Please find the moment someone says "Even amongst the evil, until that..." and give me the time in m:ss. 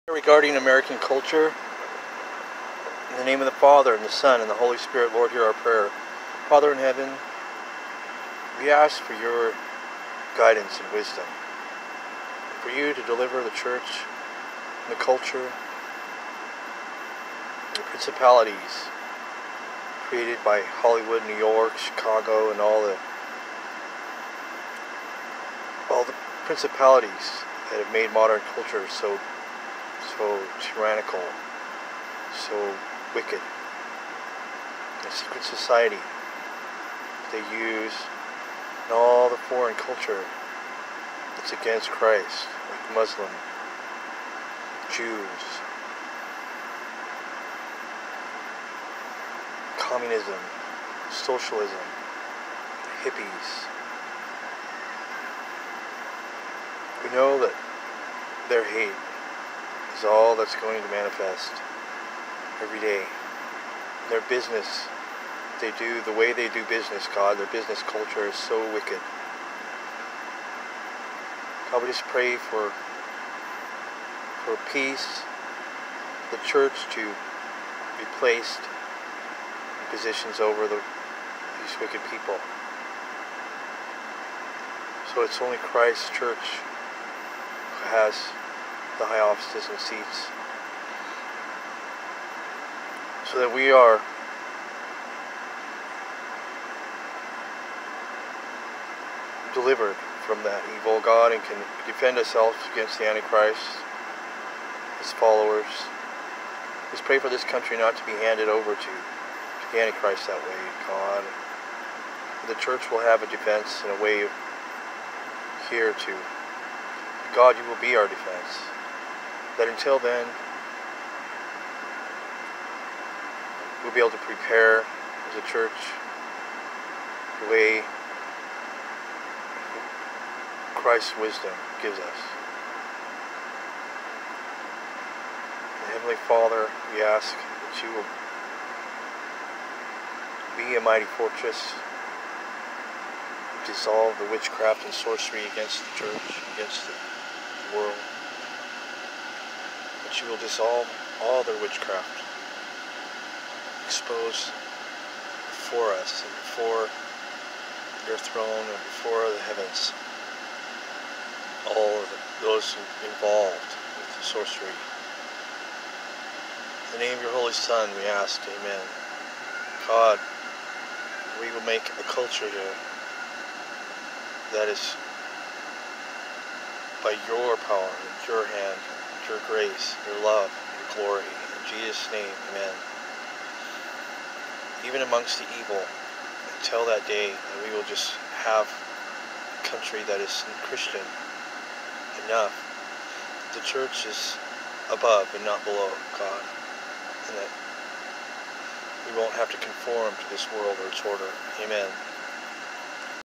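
3:04.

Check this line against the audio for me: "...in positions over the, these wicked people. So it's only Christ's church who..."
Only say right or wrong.
right.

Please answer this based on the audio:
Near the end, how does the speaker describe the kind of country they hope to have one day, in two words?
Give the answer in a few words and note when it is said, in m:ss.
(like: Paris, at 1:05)
Christian enough, at 3:10.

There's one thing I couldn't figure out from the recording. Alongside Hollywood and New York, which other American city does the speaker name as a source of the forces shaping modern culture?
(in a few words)
Chicago.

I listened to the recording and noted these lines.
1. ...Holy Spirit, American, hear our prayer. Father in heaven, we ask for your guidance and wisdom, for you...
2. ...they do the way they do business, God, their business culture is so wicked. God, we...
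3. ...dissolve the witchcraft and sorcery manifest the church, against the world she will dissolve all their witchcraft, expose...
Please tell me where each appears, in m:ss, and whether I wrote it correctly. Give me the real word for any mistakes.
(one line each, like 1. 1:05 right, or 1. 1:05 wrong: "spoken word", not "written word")
1. 0:04 wrong: "Lord", not "American"
2. 1:05 right
3. 2:23 wrong: "against", not "manifest".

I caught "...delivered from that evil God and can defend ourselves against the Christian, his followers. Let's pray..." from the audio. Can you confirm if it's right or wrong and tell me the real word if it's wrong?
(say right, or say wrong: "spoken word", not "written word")
wrong: "Antichrist", not "Christian".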